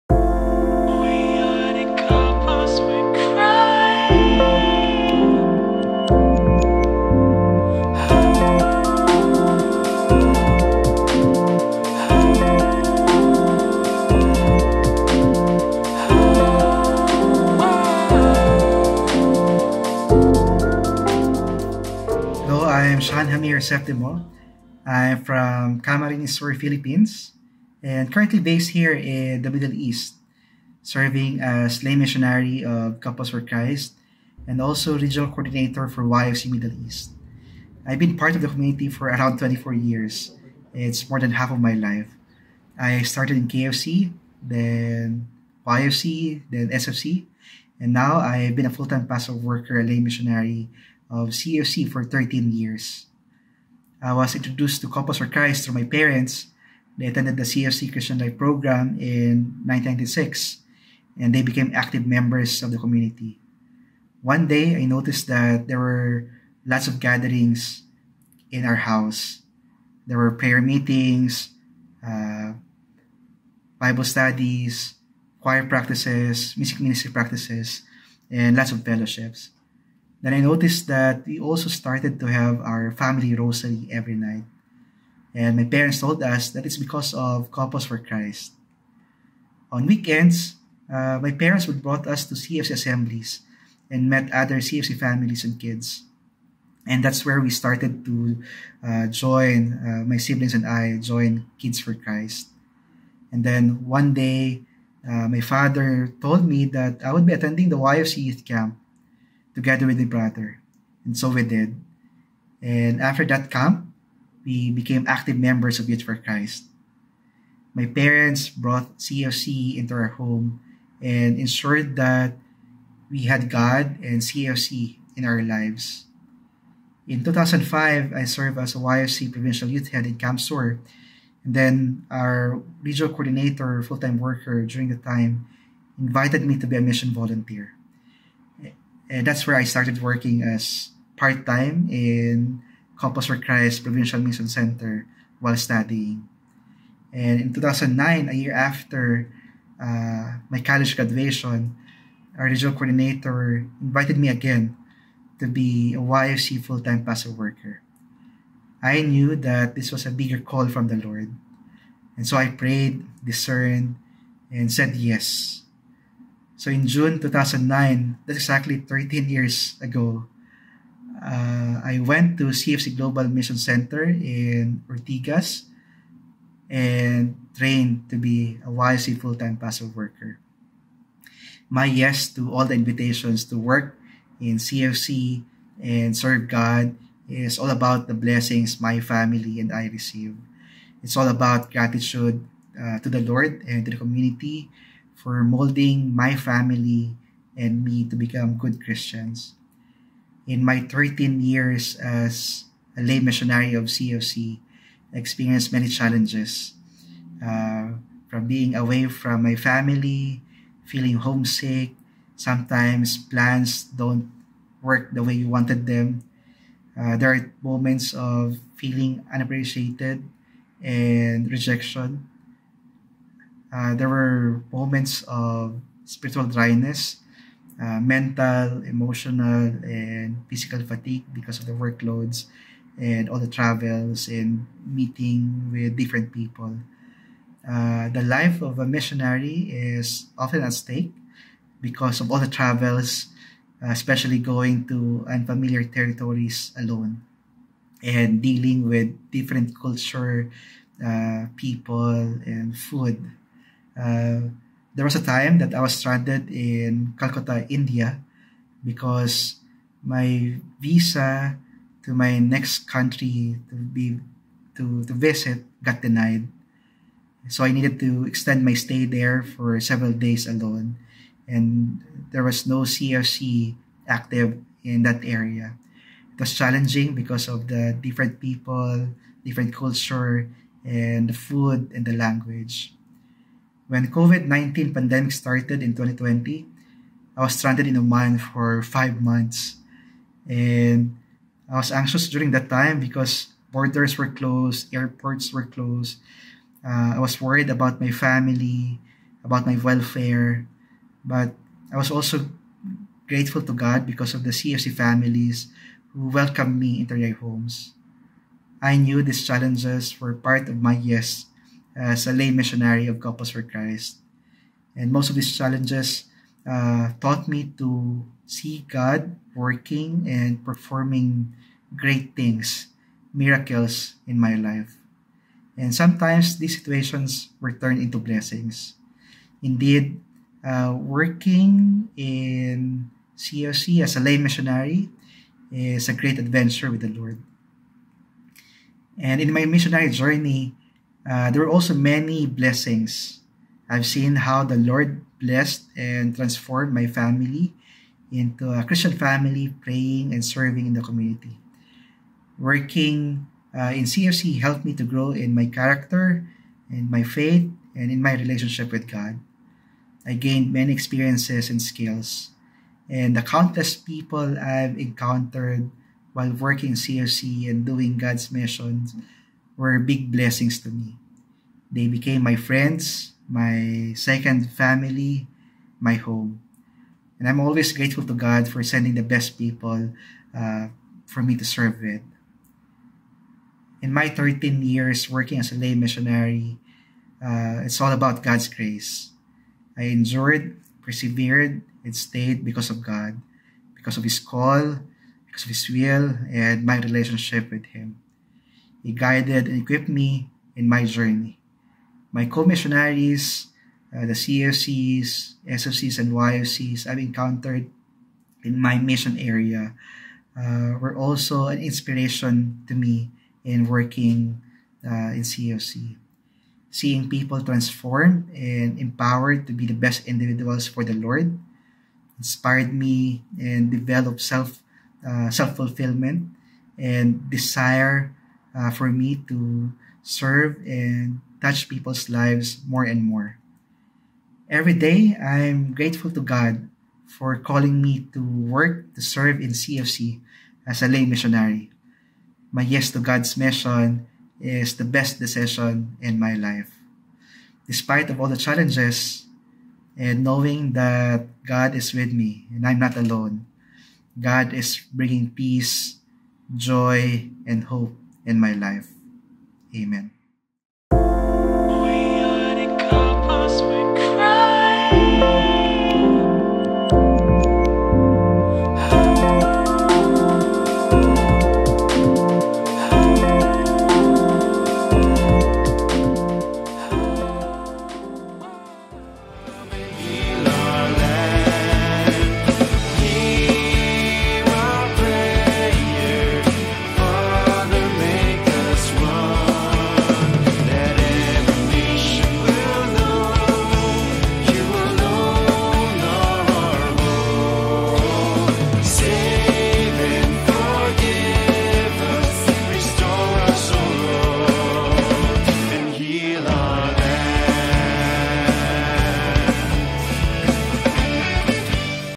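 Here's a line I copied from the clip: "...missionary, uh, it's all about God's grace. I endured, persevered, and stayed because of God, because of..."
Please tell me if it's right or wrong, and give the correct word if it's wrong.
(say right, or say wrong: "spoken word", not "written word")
right.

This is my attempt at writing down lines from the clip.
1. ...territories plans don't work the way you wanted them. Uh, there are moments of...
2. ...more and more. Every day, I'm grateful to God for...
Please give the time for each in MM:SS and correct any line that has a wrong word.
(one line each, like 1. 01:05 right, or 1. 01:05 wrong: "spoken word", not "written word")
1. 03:32 wrong: "sometimes", not "territories"
2. 07:12 right.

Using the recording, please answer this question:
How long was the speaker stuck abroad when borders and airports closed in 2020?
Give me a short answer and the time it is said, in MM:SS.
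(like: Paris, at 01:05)
5 months, at 04:48.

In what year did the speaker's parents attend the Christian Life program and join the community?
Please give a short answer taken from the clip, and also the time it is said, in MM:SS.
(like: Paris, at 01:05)
1996, at 00:59.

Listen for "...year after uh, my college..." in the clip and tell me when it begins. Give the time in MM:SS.
02:28.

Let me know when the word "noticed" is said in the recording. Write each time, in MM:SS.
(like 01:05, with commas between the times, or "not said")
01:04, 01:20.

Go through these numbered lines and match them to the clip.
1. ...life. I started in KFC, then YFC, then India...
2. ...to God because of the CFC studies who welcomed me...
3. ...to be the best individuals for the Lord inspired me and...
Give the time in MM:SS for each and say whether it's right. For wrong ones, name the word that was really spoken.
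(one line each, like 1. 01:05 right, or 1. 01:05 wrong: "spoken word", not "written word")
1. 00:41 wrong: "SFC", not "India"
2. 05:03 wrong: "families", not "studies"
3. 06:59 right.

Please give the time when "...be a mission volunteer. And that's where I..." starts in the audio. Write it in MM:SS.
02:16.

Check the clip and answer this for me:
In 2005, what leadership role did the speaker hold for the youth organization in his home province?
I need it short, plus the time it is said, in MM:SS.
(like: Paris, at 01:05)
YFC provincial youth head, at 02:08.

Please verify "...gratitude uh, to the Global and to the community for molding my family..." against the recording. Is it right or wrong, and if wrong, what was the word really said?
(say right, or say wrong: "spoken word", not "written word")
wrong: "Lord", not "Global".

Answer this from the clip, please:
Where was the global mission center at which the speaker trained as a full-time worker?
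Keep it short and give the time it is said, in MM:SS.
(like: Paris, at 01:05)
Ortigas, at 02:54.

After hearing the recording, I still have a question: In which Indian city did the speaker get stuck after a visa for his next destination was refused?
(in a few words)
Calcutta.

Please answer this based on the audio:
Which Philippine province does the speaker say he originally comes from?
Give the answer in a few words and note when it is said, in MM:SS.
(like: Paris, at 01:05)
Camarines Sur, at 00:25.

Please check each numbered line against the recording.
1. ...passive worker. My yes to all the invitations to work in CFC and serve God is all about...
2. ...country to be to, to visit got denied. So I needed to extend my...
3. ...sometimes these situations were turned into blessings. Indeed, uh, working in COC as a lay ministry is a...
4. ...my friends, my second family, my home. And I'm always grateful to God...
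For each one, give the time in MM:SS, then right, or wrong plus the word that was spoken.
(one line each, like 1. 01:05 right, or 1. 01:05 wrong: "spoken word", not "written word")
1. 02:59 right
2. 04:22 right
3. 05:25 wrong: "missionary", not "ministry"
4. 06:12 right.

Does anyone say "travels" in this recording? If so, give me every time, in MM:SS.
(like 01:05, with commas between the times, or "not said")
03:53, 04:02.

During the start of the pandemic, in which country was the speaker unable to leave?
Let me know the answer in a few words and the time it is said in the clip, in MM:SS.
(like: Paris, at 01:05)
Oman, at 04:47.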